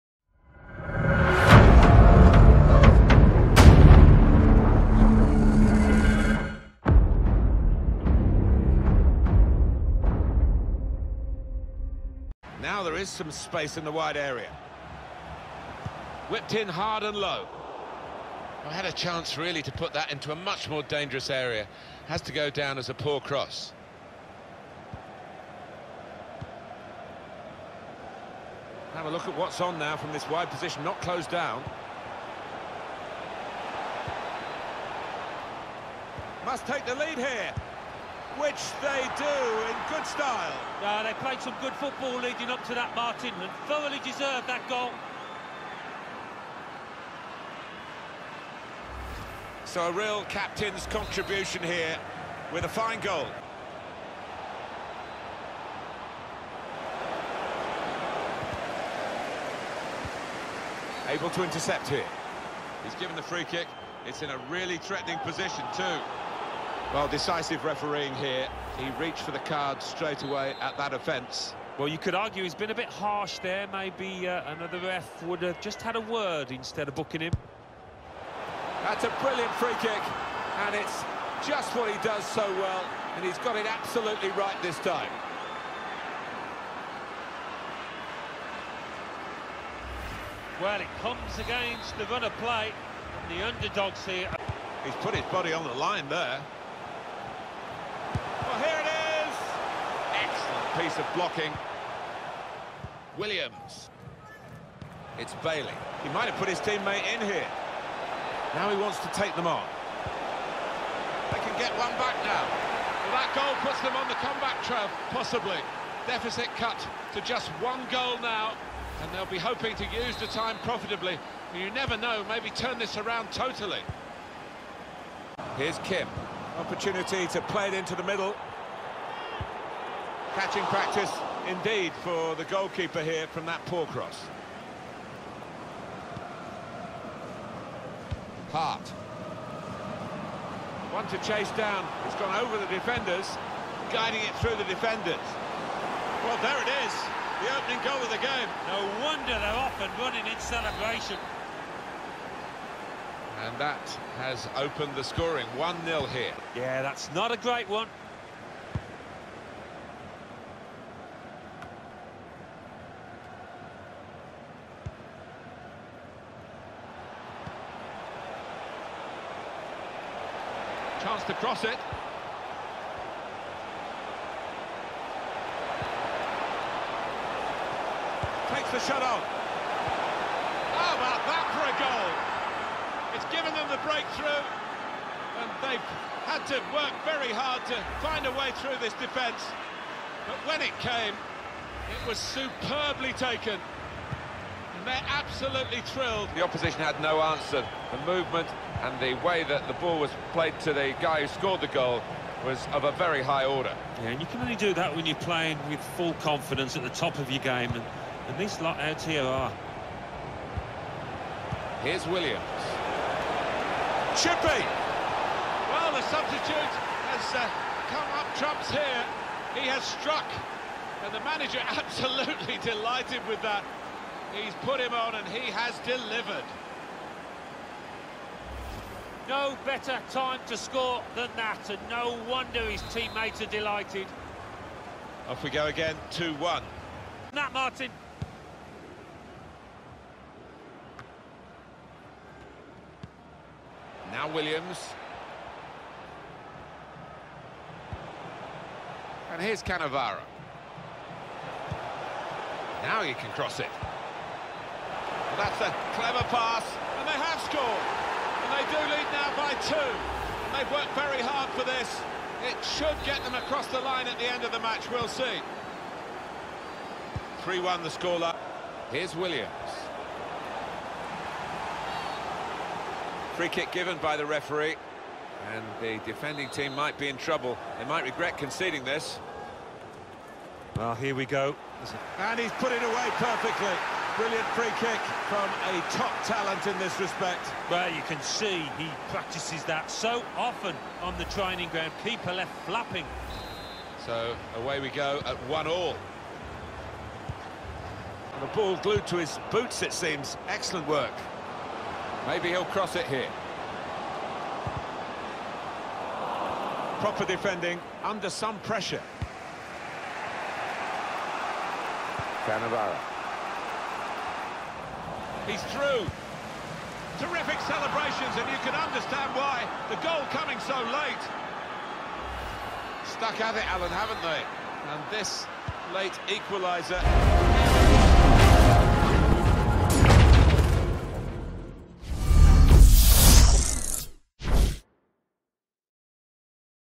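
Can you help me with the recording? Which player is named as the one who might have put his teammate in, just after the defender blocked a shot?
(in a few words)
Bailey.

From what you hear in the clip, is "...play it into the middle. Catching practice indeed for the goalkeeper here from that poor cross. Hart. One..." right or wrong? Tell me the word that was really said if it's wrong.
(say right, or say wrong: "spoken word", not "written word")
right.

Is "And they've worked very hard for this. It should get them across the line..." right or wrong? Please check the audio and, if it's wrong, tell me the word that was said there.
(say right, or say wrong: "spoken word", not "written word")
right.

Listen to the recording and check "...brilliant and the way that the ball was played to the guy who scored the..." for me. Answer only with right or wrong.
wrong.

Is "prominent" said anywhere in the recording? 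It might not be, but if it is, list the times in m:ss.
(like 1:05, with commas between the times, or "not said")
not said.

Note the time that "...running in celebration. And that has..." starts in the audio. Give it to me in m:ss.
2:29.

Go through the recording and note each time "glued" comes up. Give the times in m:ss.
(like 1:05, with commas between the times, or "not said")
4:58.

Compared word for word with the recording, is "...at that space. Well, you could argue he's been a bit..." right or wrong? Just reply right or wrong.
wrong.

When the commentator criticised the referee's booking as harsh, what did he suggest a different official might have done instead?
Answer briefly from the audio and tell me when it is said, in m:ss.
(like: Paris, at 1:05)
Had a word, at 1:15.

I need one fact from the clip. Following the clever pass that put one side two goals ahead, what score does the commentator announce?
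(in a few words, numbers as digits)
3-1.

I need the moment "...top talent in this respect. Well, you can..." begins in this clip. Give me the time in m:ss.
4:45.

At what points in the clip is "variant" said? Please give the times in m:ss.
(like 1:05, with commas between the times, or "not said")
not said.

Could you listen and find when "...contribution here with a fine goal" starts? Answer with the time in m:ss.
0:50.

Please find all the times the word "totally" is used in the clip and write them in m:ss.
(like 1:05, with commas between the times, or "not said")
2:03.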